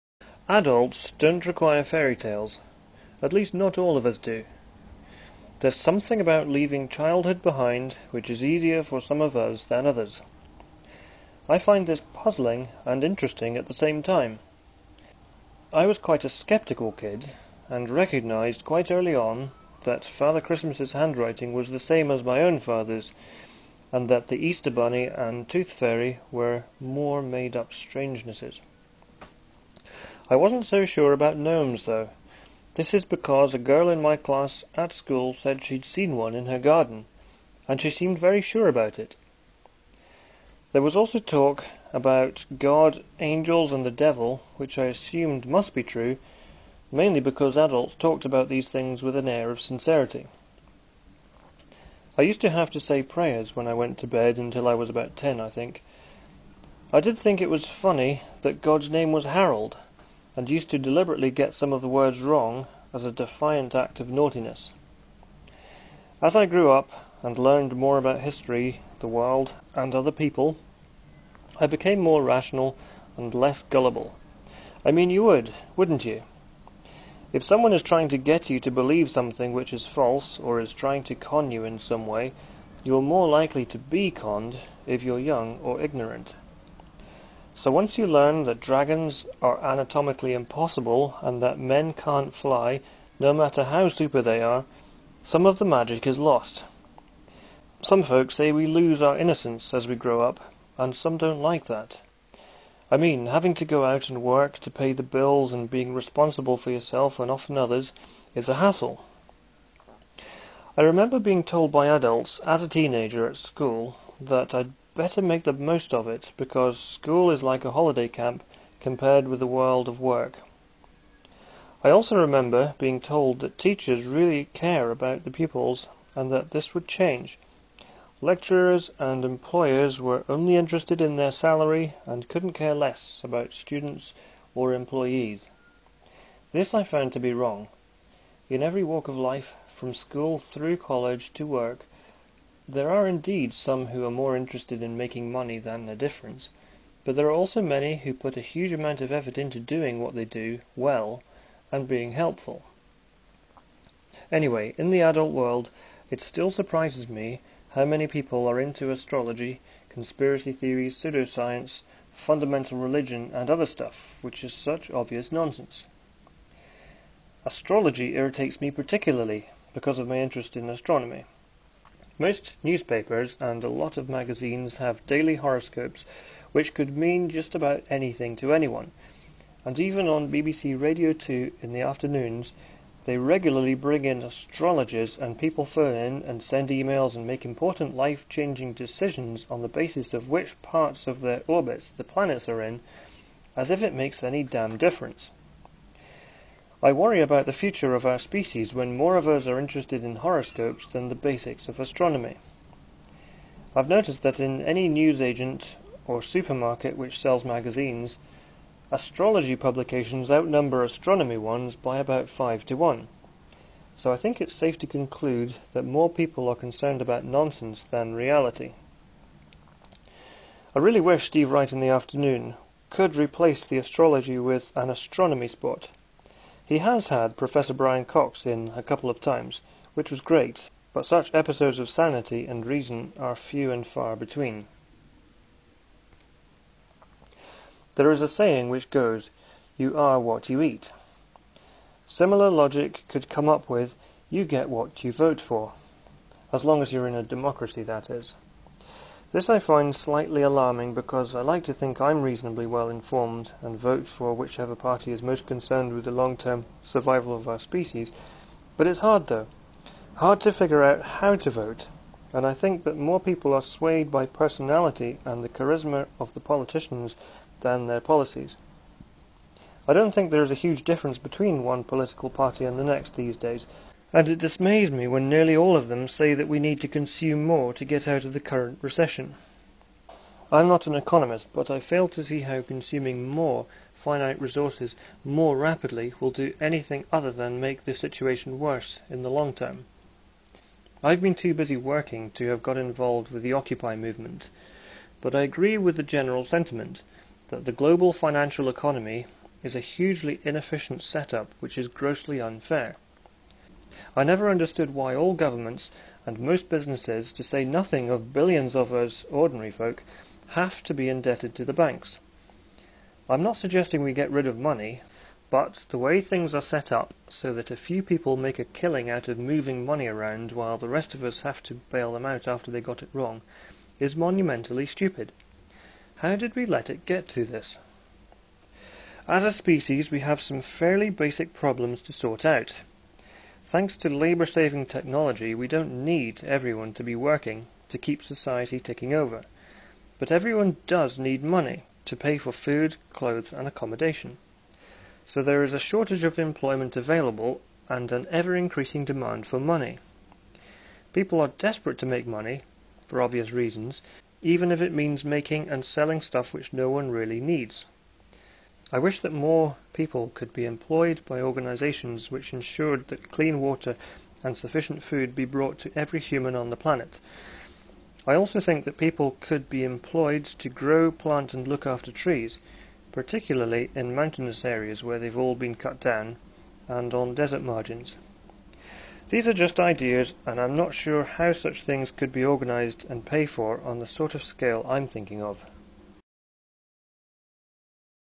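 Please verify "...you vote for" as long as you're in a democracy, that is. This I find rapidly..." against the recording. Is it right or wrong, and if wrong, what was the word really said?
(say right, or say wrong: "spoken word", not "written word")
wrong: "slightly", not "rapidly".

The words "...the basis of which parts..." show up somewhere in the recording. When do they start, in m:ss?
3:09.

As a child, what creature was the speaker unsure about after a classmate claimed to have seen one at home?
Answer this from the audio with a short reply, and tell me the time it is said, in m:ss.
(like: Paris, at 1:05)
gnomes, at 0:31.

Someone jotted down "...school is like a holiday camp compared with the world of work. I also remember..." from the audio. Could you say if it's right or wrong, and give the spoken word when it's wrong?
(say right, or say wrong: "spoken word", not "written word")
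right.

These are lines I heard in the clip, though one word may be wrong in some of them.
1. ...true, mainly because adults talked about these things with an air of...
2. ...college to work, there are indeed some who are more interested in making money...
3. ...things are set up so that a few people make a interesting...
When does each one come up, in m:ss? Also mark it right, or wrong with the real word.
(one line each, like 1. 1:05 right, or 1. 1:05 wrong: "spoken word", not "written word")
1. 0:45 right
2. 2:20 right
3. 5:16 wrong: "killing", not "interesting".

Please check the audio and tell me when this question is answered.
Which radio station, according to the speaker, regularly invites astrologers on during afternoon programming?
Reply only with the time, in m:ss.
3:00.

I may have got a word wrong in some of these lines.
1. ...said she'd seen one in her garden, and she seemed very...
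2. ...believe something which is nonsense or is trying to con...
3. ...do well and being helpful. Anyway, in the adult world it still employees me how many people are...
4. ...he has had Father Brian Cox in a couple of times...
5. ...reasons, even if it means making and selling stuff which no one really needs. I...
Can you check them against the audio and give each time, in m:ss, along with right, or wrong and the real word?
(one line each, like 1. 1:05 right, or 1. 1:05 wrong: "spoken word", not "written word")
1. 0:35 right
2. 1:18 wrong: "false", not "nonsense"
3. 2:30 wrong: "surprises", not "employees"
4. 3:46 wrong: "Professor", not "Father"
5. 5:53 right.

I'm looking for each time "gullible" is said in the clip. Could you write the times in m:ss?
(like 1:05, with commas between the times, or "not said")
1:13.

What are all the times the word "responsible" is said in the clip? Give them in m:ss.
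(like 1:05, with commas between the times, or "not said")
1:45.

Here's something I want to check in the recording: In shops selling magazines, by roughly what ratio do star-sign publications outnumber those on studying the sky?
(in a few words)
5 to 1.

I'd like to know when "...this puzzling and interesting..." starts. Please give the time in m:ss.
0:11.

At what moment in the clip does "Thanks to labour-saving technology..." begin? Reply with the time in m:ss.
5:33.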